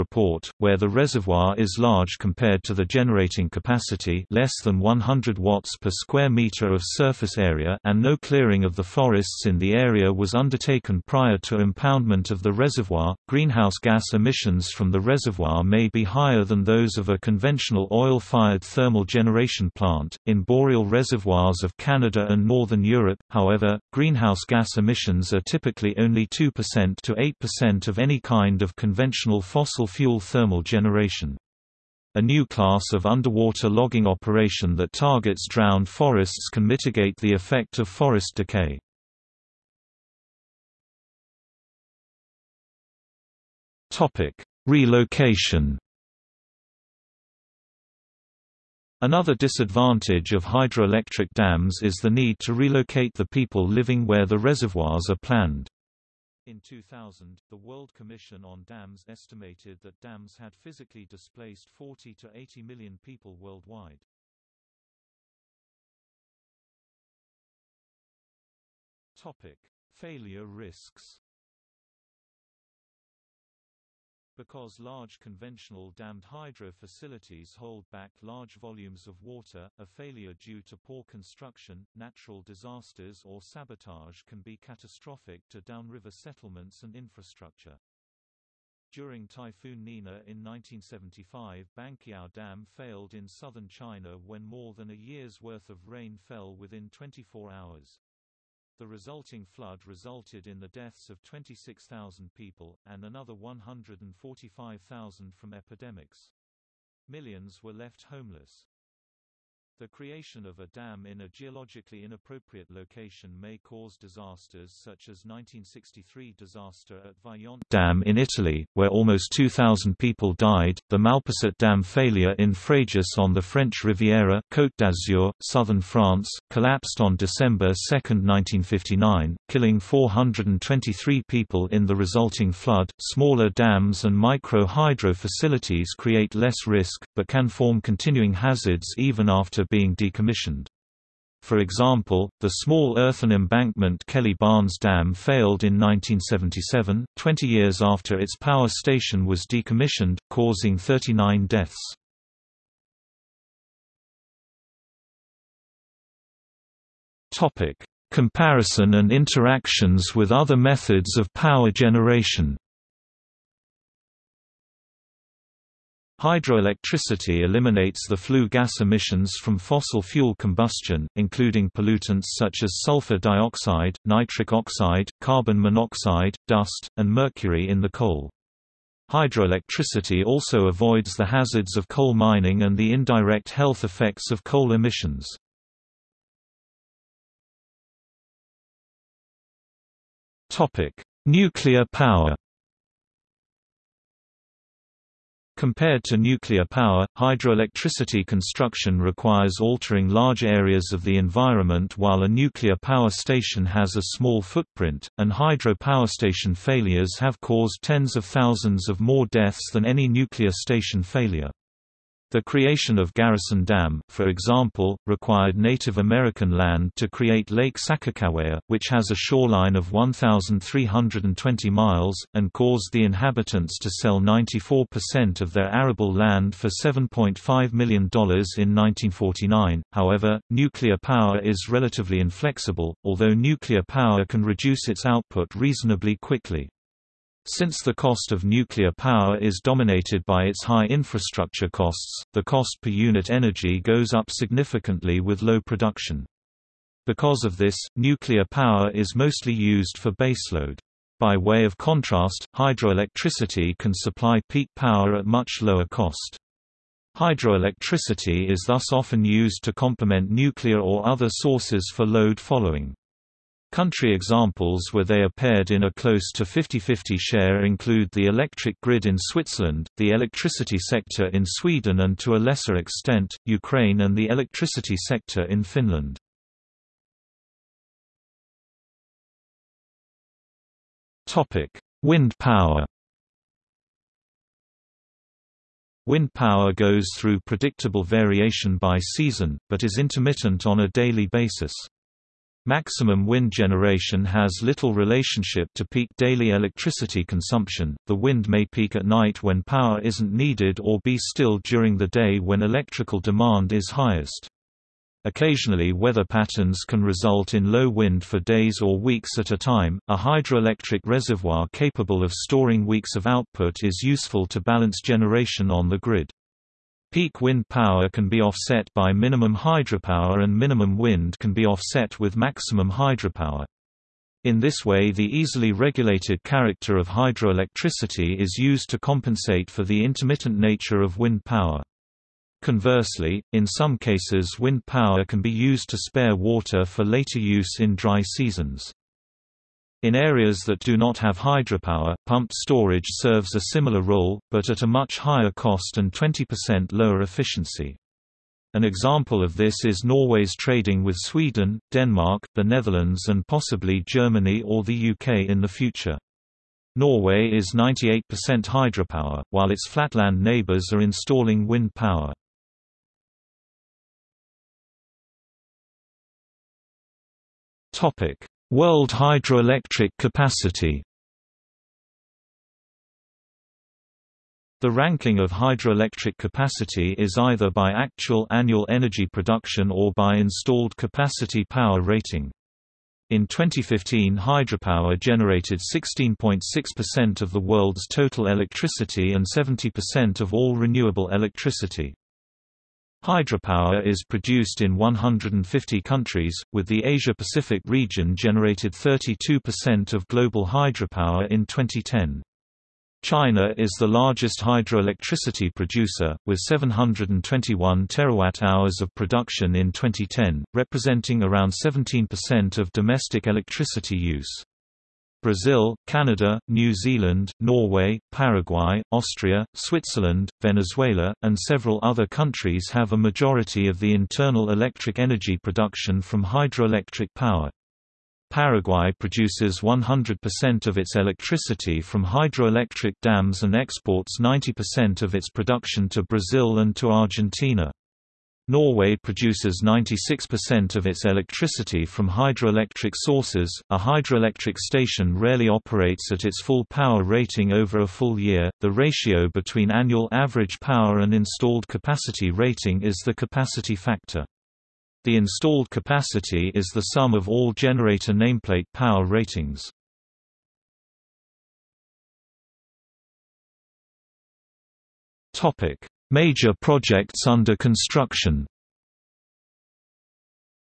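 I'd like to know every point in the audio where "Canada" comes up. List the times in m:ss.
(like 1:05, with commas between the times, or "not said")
0:21, 6:56.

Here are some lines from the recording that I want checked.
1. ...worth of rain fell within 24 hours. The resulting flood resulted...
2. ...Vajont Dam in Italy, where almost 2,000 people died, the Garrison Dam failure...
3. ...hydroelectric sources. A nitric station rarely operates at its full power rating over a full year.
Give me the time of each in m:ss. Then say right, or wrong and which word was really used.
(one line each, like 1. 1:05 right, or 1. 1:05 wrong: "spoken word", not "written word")
1. 1:35 right
2. 1:57 wrong: "Malpasset", not "Garrison"
3. 7:22 wrong: "hydroelectric", not "nitric".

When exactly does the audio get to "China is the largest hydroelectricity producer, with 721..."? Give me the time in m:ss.
6:43.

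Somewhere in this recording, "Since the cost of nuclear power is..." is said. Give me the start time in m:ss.
3:57.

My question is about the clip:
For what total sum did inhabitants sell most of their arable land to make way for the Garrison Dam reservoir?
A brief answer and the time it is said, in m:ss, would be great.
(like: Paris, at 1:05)
$7.5 million, at 3:46.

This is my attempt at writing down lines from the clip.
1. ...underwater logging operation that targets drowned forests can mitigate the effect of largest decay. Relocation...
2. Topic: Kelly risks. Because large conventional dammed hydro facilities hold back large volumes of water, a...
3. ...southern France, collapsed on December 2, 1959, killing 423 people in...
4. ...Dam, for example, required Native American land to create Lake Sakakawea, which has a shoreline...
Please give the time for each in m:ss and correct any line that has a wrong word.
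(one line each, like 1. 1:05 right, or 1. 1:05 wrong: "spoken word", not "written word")
1. 0:33 wrong: "forest", not "largest"
2. 1:09 wrong: "Failure", not "Kelly"
3. 2:05 right
4. 3:33 right.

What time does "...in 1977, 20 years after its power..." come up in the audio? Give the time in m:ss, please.
2:25.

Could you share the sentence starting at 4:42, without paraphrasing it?
Wind power Wind power goes through predictable variation by season, but is intermittent on a daily basis.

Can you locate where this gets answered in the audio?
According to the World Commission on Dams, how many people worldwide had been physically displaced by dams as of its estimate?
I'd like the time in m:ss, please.
1:01.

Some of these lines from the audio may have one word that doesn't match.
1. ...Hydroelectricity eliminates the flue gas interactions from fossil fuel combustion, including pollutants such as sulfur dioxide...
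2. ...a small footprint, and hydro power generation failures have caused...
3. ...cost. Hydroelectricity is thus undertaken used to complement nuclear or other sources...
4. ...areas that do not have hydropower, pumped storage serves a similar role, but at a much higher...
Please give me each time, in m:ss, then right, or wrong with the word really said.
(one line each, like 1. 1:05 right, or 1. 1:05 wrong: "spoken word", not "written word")
1. 2:46 wrong: "emissions", not "interactions"
2. 3:23 wrong: "station", not "generation"
3. 4:15 wrong: "often", not "undertaken"
4. 5:40 right.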